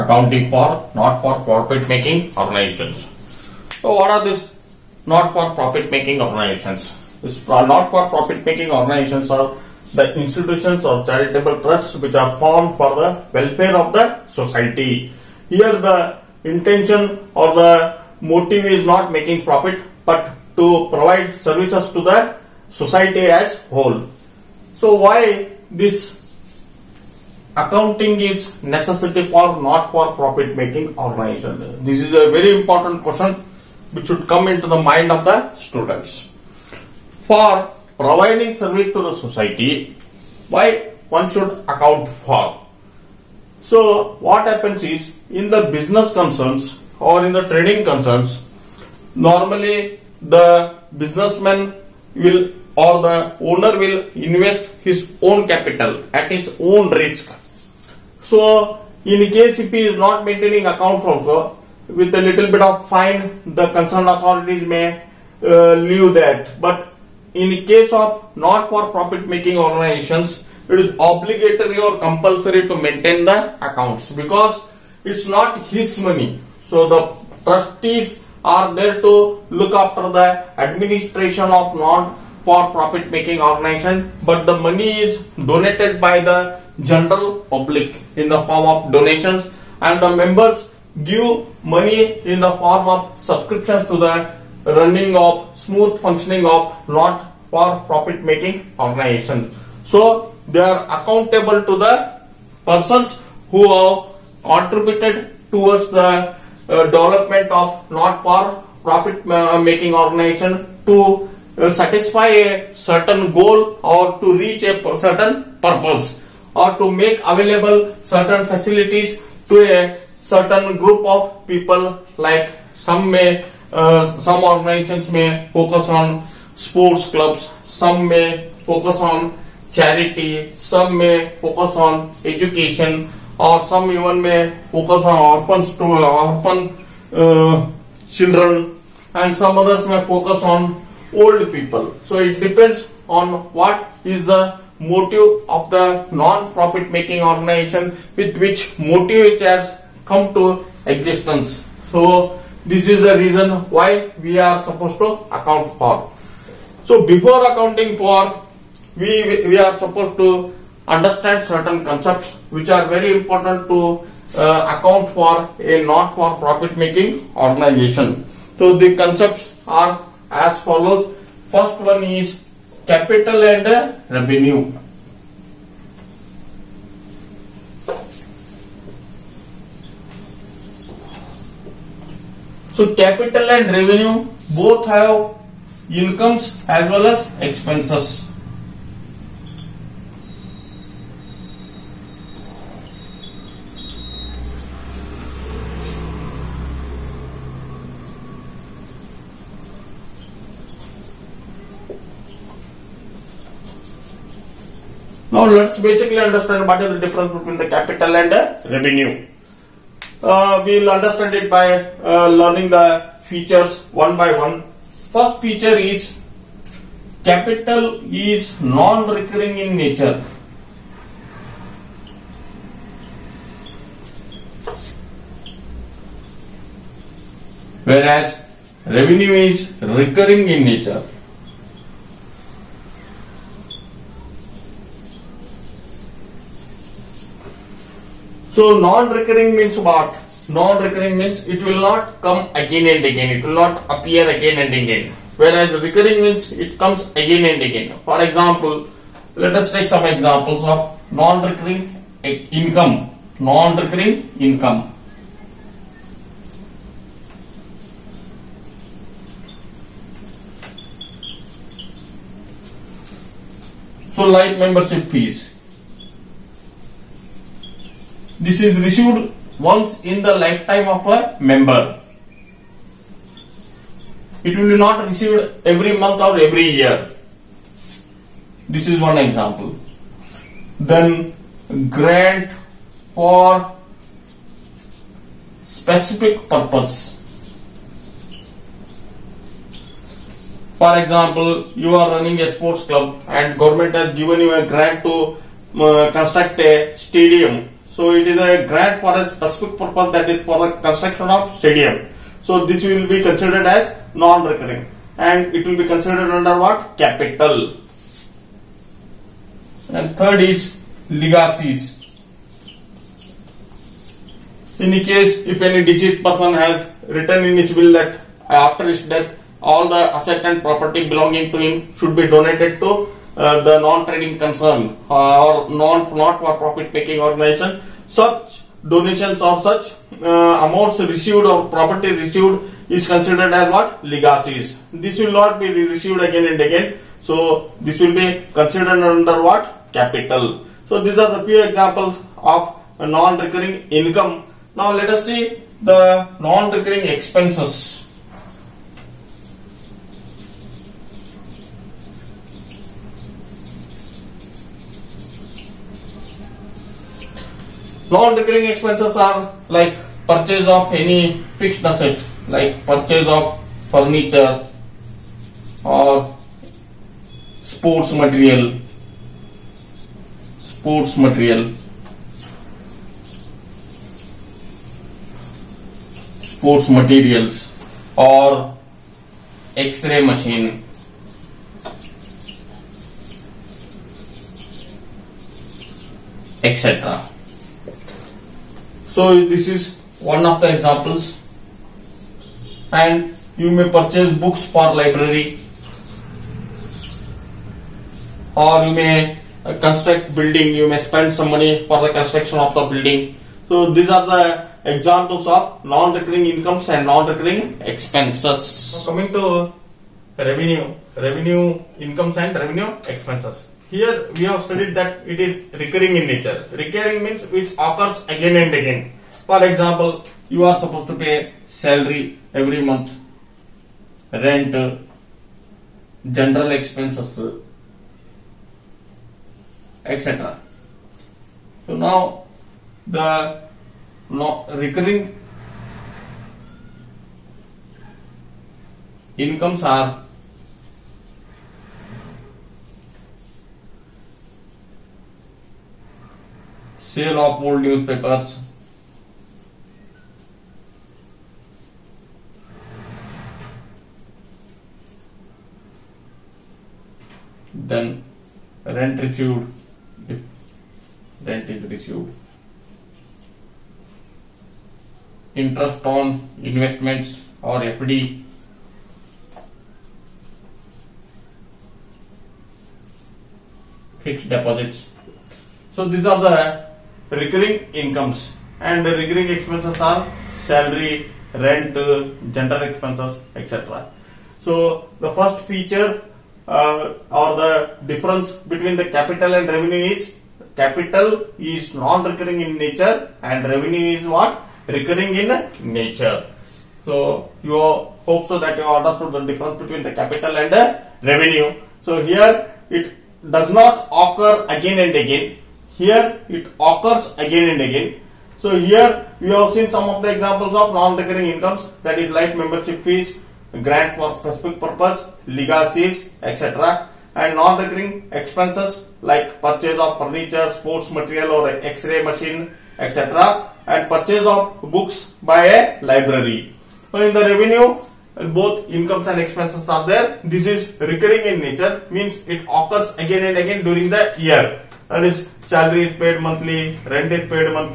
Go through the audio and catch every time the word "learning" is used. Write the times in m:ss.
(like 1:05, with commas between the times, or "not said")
3:32.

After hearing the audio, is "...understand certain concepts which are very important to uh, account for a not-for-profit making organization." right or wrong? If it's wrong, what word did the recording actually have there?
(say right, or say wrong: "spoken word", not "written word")
right.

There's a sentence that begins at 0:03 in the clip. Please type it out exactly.
So what are these not for profit making organizations?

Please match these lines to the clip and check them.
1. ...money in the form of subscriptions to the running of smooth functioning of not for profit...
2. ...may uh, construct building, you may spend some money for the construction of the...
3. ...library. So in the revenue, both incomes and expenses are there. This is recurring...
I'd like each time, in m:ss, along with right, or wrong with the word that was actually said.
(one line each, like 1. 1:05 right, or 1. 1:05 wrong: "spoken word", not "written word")
1. 1:31 right
2. 6:38 right
3. 8:46 right.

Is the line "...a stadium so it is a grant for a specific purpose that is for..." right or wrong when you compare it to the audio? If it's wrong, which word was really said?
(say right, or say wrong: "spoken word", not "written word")
right.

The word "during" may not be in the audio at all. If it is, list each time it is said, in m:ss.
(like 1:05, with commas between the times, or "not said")
8:53.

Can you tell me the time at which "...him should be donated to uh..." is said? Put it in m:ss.
5:21.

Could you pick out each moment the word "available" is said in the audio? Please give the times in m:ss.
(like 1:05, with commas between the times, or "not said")
1:57.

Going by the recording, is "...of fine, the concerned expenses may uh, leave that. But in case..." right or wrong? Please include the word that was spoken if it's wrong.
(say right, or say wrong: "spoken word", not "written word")
wrong: "authorities", not "expenses".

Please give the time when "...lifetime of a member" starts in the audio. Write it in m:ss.
4:30.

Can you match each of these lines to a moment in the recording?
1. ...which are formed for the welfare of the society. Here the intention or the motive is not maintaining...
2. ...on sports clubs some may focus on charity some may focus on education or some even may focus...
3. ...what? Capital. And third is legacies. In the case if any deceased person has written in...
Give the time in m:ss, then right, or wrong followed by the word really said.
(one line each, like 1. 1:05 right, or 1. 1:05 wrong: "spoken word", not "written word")
1. 0:11 wrong: "making", not "maintaining"
2. 2:05 right
3. 5:06 right.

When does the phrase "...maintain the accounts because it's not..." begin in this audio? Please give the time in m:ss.
1:12.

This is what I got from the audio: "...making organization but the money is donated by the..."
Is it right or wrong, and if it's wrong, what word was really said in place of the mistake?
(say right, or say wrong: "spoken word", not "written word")
right.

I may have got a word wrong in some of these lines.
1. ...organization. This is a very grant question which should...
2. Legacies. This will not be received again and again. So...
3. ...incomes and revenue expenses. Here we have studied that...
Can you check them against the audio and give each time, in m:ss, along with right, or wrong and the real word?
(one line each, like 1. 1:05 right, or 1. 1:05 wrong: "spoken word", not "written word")
1. 0:30 wrong: "important", not "grant"
2. 5:34 right
3. 6:51 right.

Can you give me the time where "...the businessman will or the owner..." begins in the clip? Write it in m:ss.
0:50.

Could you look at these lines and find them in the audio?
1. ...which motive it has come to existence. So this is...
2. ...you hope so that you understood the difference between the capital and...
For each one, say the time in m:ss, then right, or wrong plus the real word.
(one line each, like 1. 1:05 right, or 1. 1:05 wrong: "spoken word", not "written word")
1. 2:28 right
2. 8:17 right.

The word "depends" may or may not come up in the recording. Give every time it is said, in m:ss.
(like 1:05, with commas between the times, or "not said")
2:22.